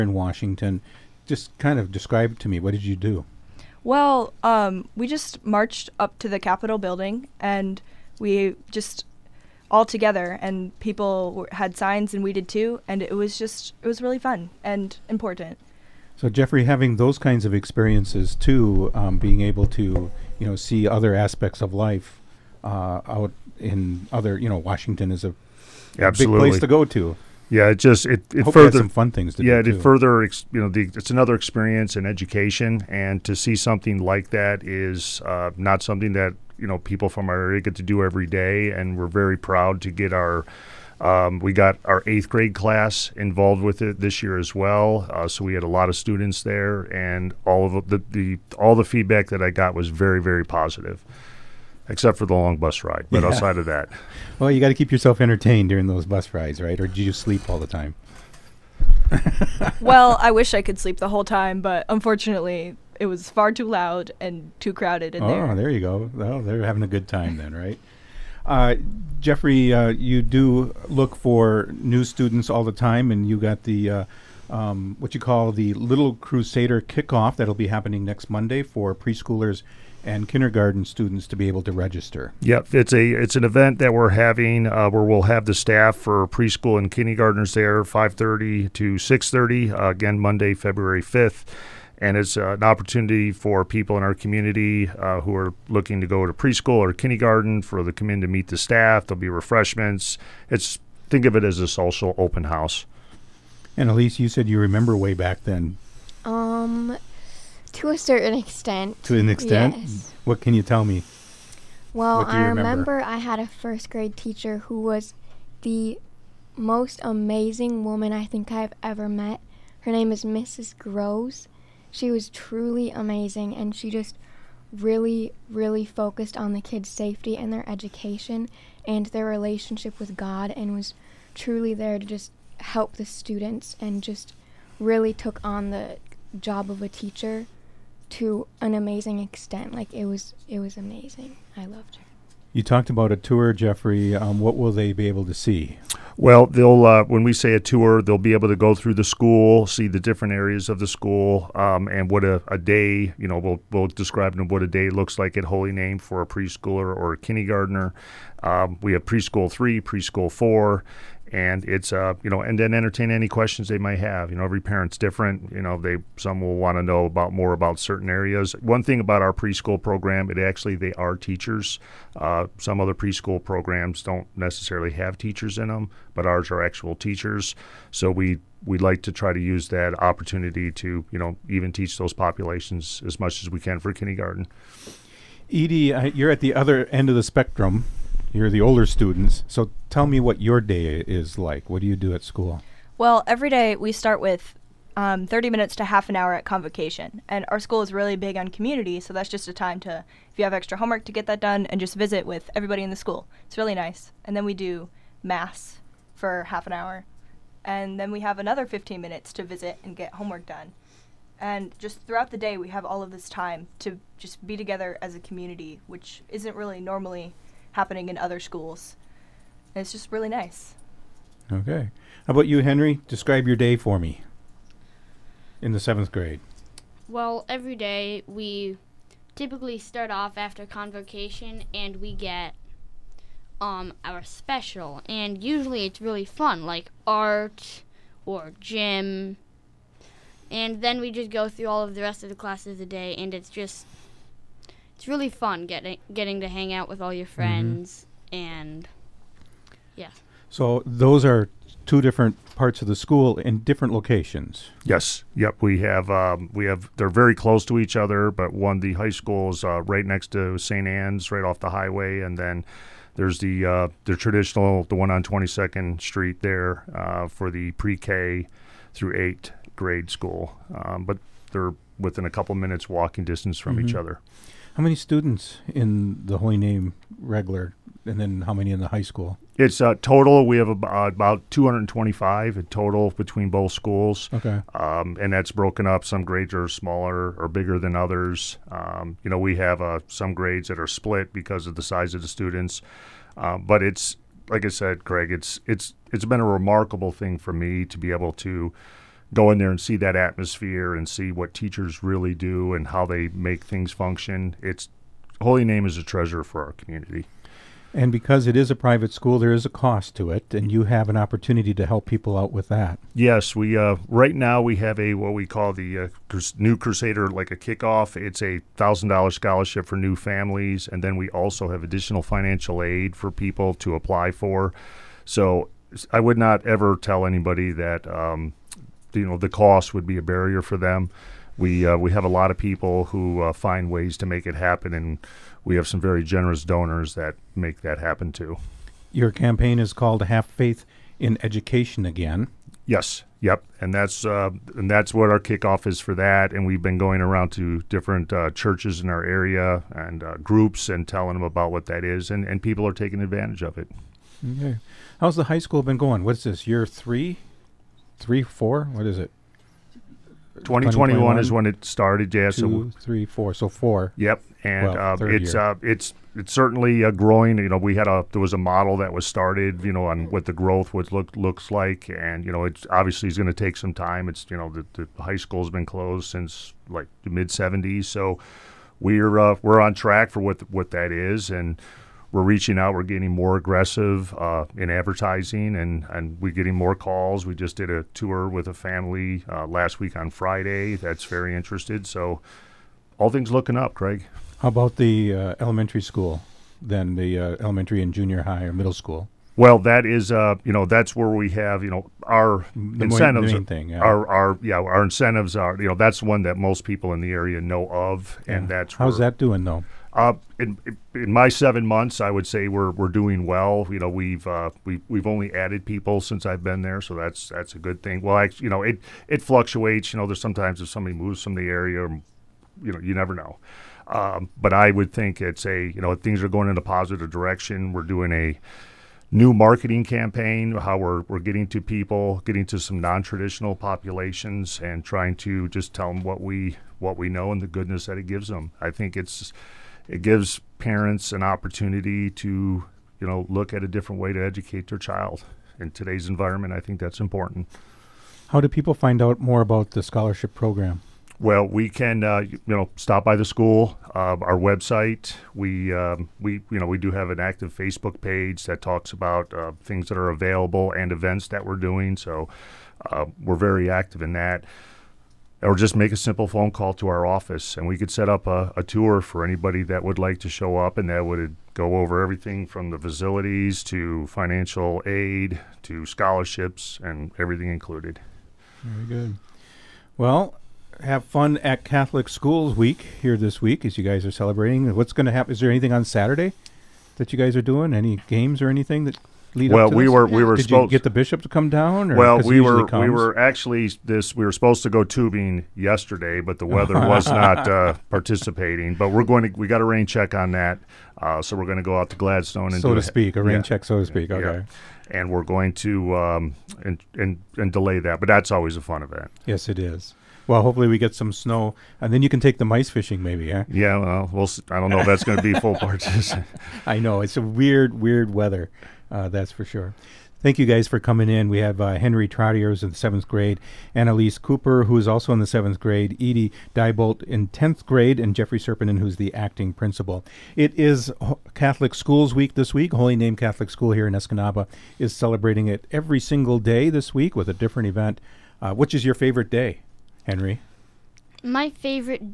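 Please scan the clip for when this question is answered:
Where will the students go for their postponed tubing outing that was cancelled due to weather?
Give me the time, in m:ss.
8:22.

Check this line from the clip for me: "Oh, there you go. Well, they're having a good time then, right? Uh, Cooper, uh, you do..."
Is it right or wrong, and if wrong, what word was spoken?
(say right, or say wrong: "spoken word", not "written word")
wrong: "Jeffrey", not "Cooper".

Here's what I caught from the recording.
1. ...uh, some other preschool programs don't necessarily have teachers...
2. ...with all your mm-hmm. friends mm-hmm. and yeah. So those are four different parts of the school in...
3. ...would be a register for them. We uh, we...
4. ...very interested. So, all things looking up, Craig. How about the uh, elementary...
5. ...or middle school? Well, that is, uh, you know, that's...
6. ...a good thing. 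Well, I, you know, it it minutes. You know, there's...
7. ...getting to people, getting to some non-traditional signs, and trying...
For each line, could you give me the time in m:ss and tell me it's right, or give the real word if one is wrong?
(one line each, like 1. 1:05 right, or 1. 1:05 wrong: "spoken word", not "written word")
1. 2:52 right
2. 4:06 wrong: "two", not "four"
3. 5:29 wrong: "barrier", not "register"
4. 6:31 right
5. 6:38 right
6. 6:57 wrong: "fluctuates", not "minutes"
7. 7:11 wrong: "populations", not "signs".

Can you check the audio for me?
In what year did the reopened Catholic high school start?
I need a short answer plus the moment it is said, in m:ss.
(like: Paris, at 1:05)
2021, at 6:00.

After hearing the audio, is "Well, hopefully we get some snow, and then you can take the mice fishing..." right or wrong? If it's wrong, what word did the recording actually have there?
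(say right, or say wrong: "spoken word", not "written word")
right.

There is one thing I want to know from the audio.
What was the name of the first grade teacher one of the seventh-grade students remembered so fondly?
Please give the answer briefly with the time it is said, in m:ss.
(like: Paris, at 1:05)
Mrs. Groves, at 2:00.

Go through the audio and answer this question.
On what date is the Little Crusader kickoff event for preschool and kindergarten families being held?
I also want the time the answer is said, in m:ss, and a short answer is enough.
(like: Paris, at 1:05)
February 5th, at 1:30.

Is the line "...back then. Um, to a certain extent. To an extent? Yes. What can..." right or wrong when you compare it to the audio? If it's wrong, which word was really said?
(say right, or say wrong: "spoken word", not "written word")
right.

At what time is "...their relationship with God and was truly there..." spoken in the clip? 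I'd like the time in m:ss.
2:09.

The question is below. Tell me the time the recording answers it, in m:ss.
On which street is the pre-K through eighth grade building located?
4:25.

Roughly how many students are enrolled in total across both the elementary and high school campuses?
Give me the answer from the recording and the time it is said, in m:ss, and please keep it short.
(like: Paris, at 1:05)
225, at 4:41.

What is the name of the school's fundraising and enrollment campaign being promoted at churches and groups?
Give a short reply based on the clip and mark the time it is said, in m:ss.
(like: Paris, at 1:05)
Have Faith in Education, at 5:40.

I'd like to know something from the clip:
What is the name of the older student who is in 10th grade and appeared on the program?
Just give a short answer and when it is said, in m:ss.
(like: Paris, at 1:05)
Edie Diebolt, at 8:46.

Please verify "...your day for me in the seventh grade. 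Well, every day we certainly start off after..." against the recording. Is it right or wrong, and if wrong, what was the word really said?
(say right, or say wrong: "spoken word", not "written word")
wrong: "typically", not "certainly".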